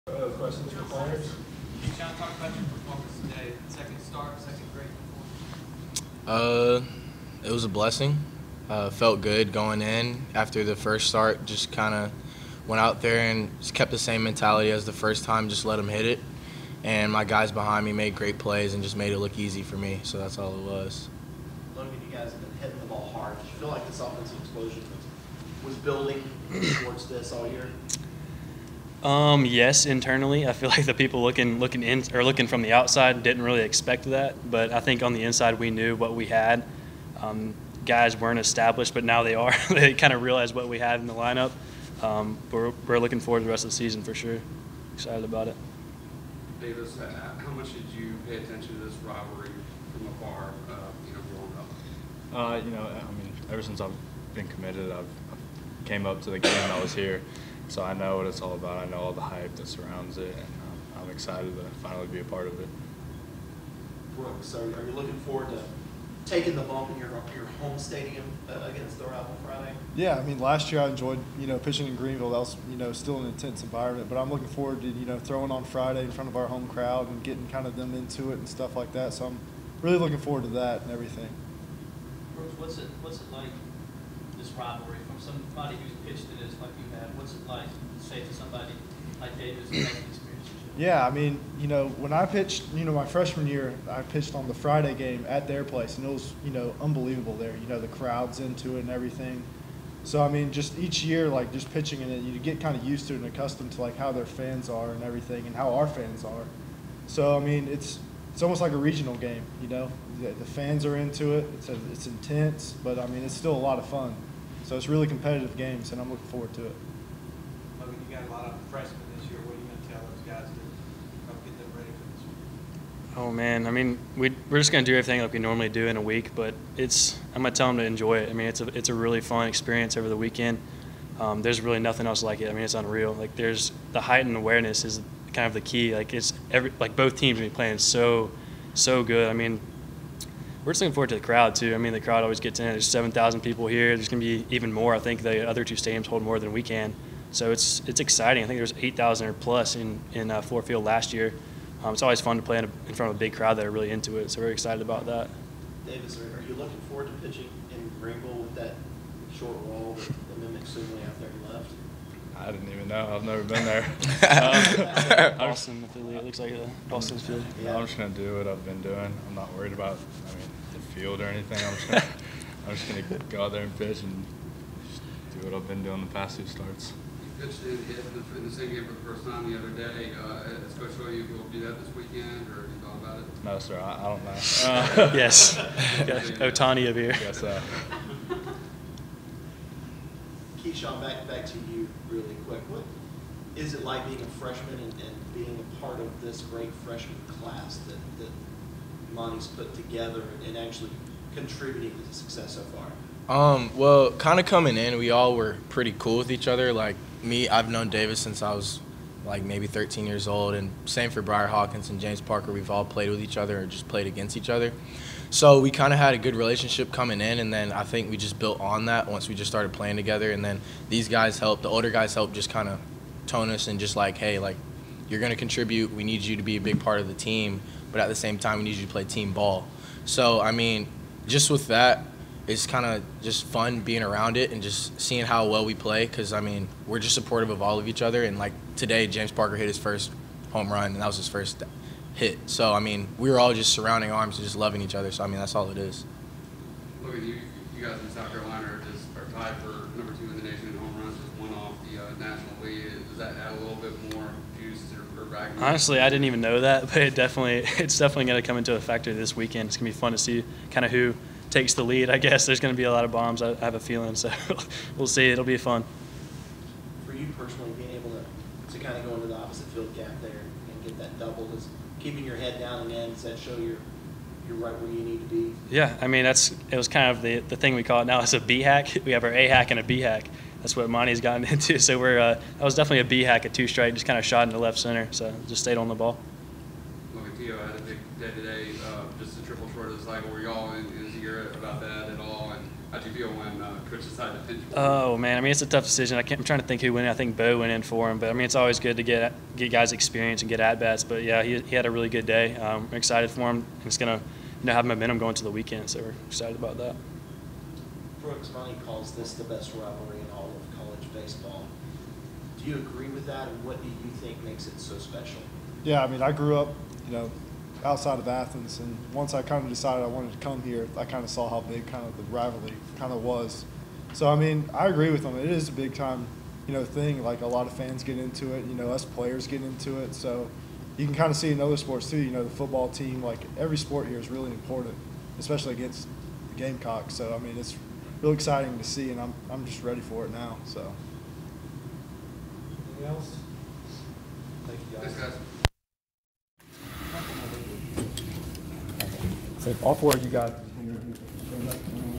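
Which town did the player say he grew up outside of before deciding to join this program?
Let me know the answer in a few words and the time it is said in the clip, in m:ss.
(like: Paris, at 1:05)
Athens, at 5:18.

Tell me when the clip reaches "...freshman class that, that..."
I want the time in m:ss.
3:16.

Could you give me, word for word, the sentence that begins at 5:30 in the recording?
So you can kind of see in other sports too.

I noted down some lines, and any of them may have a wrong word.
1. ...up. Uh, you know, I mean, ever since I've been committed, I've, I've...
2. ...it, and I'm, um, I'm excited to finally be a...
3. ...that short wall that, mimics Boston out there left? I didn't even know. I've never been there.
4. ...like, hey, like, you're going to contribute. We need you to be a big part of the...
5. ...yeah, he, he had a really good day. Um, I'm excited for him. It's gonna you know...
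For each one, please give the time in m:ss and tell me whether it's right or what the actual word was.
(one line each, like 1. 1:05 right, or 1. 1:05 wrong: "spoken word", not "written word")
1. 0:52 right
2. 1:00 right
3. 2:38 wrong: "Sibley", not "Boston"
4. 3:43 right
5. 5:01 right.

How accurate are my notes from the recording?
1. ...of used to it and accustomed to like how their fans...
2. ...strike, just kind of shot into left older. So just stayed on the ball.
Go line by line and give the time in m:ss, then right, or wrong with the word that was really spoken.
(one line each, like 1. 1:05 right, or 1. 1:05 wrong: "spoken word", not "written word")
1. 1:42 right
2. 4:43 wrong: "center", not "older".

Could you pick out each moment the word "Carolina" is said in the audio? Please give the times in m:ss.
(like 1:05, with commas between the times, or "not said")
4:08.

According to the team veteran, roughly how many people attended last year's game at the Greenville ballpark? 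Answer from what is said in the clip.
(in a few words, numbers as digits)
8,000.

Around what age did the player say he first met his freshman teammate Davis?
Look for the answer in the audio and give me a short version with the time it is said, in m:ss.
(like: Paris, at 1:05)
13, at 3:29.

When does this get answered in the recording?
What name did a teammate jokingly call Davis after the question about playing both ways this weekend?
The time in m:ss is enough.
3:05.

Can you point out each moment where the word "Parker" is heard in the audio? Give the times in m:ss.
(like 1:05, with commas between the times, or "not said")
3:32, 3:59.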